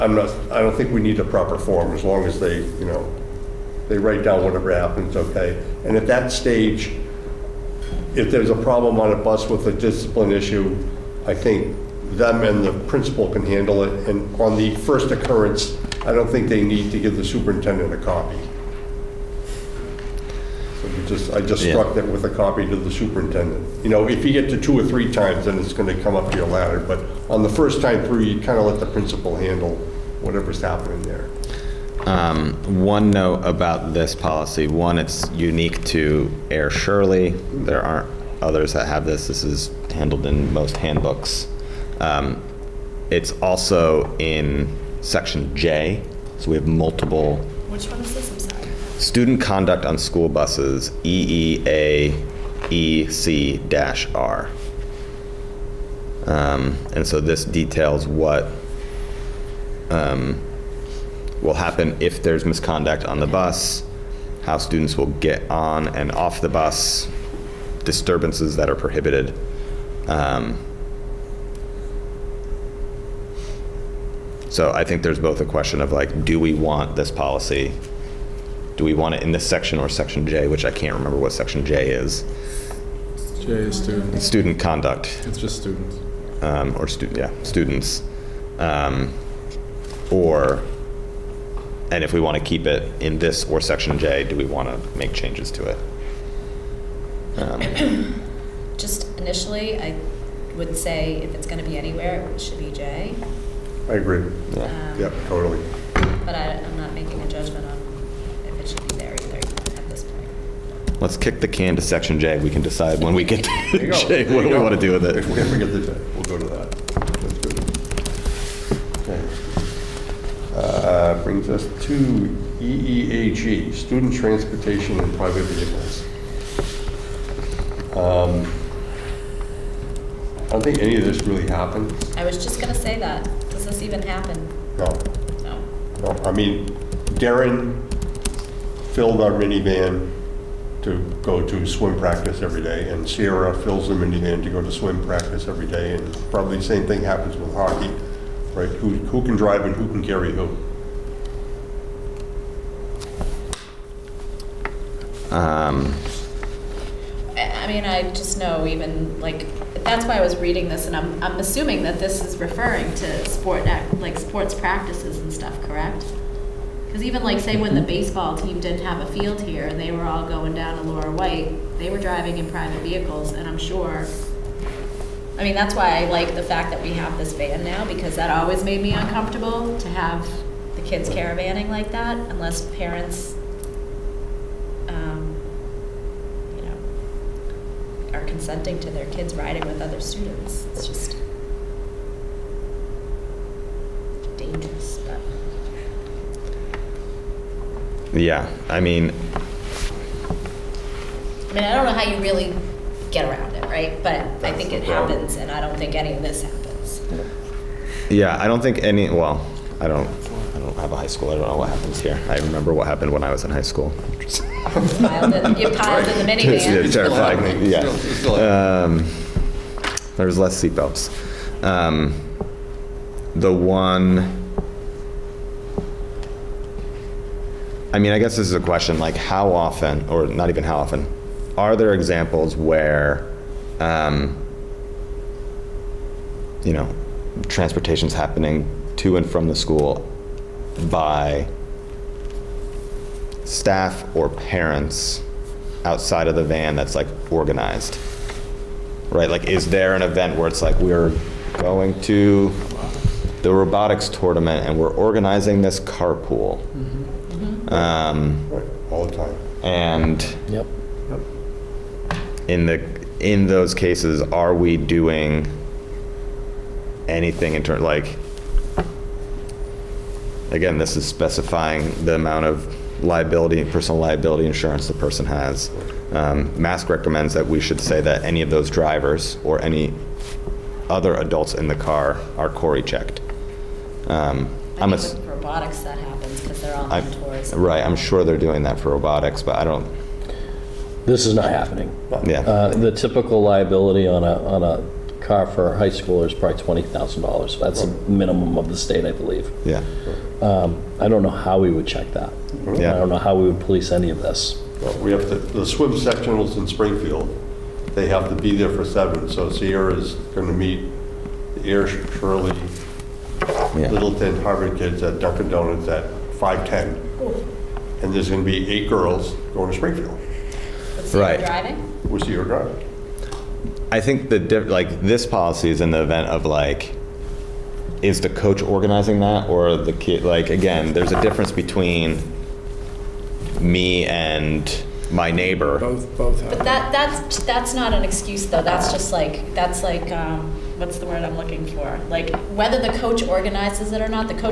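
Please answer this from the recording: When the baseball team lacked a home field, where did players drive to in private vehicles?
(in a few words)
Lura White.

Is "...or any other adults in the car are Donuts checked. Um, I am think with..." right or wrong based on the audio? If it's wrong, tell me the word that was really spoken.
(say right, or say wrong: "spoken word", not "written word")
wrong: "CORI", not "Donuts".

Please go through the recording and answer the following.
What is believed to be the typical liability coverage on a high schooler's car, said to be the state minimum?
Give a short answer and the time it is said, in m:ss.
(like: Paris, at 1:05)
$20,000, at 4:56.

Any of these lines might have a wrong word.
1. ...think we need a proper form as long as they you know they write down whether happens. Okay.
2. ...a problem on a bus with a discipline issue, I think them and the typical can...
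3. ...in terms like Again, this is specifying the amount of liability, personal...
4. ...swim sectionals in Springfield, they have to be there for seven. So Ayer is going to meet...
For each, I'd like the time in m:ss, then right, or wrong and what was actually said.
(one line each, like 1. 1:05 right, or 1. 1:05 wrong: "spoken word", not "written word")
1. 0:00 wrong: "whatever", not "whether"
2. 0:08 wrong: "principal", not "typical"
3. 4:27 right
4. 5:05 wrong: "Sierra", not "Ayer".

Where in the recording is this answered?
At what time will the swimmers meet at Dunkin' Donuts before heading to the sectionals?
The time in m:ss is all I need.
5:16.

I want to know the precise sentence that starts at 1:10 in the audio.
Um, so I think there's both a question of like, do we want this policy?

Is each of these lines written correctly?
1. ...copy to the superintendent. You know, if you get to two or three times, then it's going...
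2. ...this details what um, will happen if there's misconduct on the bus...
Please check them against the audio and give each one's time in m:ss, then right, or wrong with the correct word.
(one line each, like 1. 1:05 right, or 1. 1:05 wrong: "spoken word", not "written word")
1. 0:22 right
2. 0:57 right.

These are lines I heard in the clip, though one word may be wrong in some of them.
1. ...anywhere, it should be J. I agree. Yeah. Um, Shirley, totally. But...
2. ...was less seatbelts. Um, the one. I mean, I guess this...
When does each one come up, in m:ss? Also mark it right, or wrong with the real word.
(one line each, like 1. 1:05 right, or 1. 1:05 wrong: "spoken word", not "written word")
1. 1:41 wrong: "Yep", not "Shirley"
2. 3:40 right.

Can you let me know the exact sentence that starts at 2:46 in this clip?
Because even like say when the mm-hmm.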